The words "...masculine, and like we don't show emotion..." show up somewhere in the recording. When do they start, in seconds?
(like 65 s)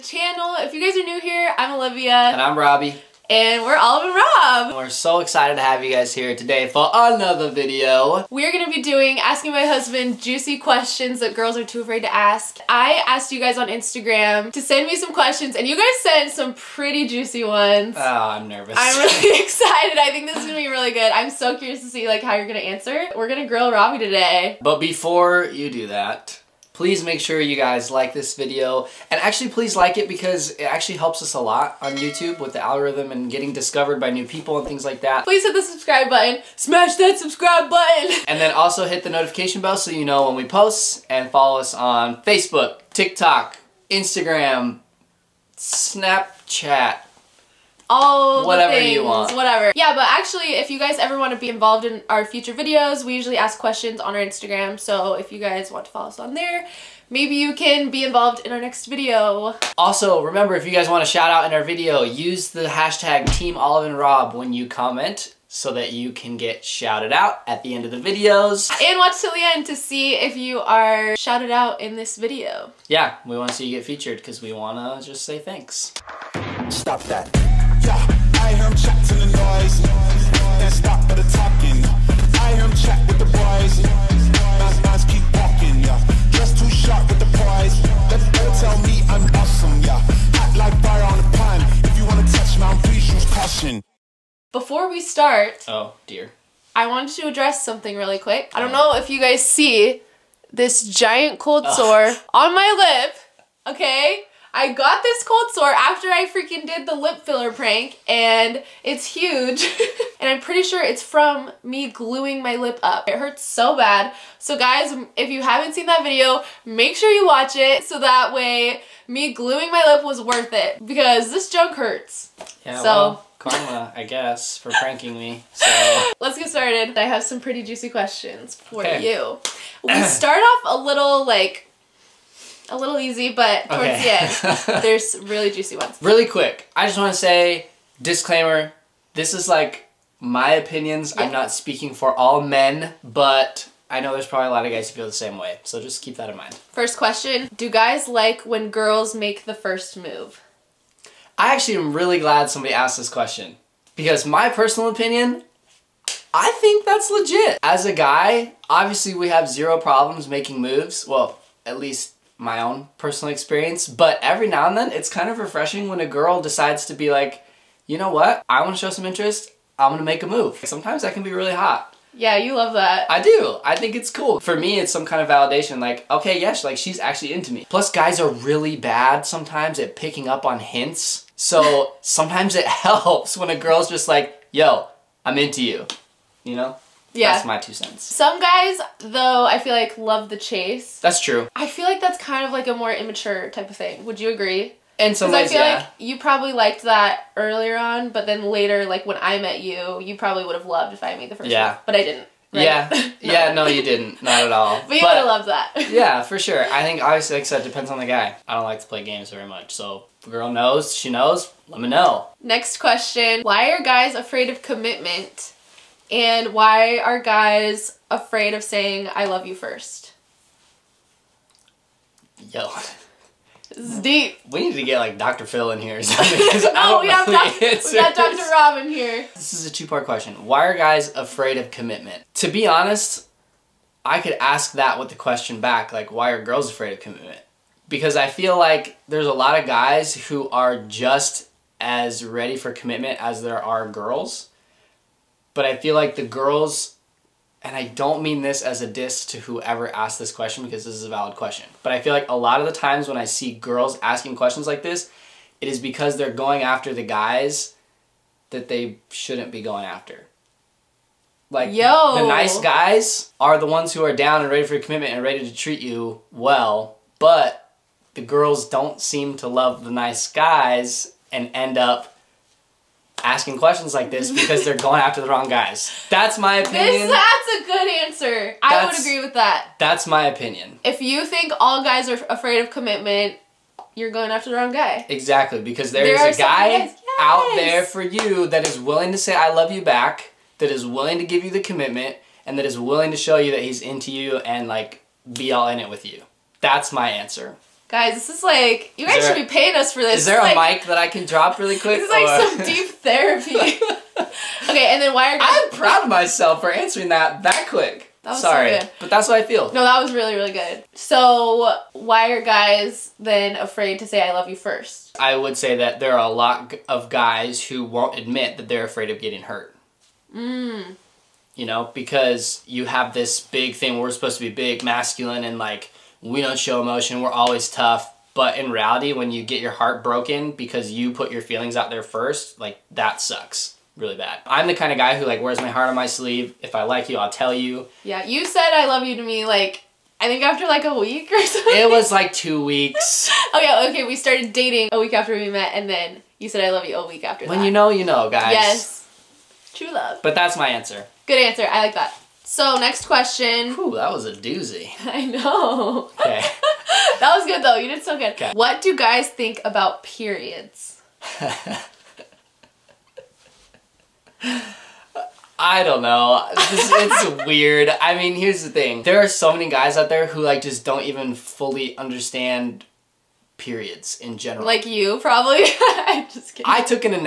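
324 s.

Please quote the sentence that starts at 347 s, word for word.
When you know, you know, guys.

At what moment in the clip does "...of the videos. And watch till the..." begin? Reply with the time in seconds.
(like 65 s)
67 s.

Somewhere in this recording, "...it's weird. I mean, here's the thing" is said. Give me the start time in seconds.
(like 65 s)
366 s.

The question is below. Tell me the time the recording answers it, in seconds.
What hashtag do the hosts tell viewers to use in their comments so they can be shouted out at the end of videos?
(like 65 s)
63 s.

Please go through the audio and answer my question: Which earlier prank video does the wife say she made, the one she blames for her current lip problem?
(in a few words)
lip filler prank.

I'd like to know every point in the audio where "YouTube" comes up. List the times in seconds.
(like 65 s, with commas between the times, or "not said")
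31 s.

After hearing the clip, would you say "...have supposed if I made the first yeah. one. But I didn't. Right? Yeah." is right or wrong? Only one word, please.
wrong.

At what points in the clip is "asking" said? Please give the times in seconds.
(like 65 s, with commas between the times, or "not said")
9 s, 254 s, 273 s.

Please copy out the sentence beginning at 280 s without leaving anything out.
If you think all guys are afraid of commitment, you're going after the wrong guy.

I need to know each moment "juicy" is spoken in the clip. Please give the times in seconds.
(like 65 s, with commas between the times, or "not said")
10 s, 17 s, 127 s, 135 s.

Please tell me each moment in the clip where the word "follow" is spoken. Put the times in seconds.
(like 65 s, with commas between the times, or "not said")
41 s, 55 s.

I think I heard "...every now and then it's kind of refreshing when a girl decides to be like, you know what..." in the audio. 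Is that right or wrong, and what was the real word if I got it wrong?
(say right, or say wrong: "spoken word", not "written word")
right.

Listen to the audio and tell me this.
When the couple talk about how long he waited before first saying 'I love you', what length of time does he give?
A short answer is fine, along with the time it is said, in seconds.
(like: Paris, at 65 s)
2 weeks, at 342 s.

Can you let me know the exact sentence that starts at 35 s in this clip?
Please hit the subscribe button, smash that subscribe button!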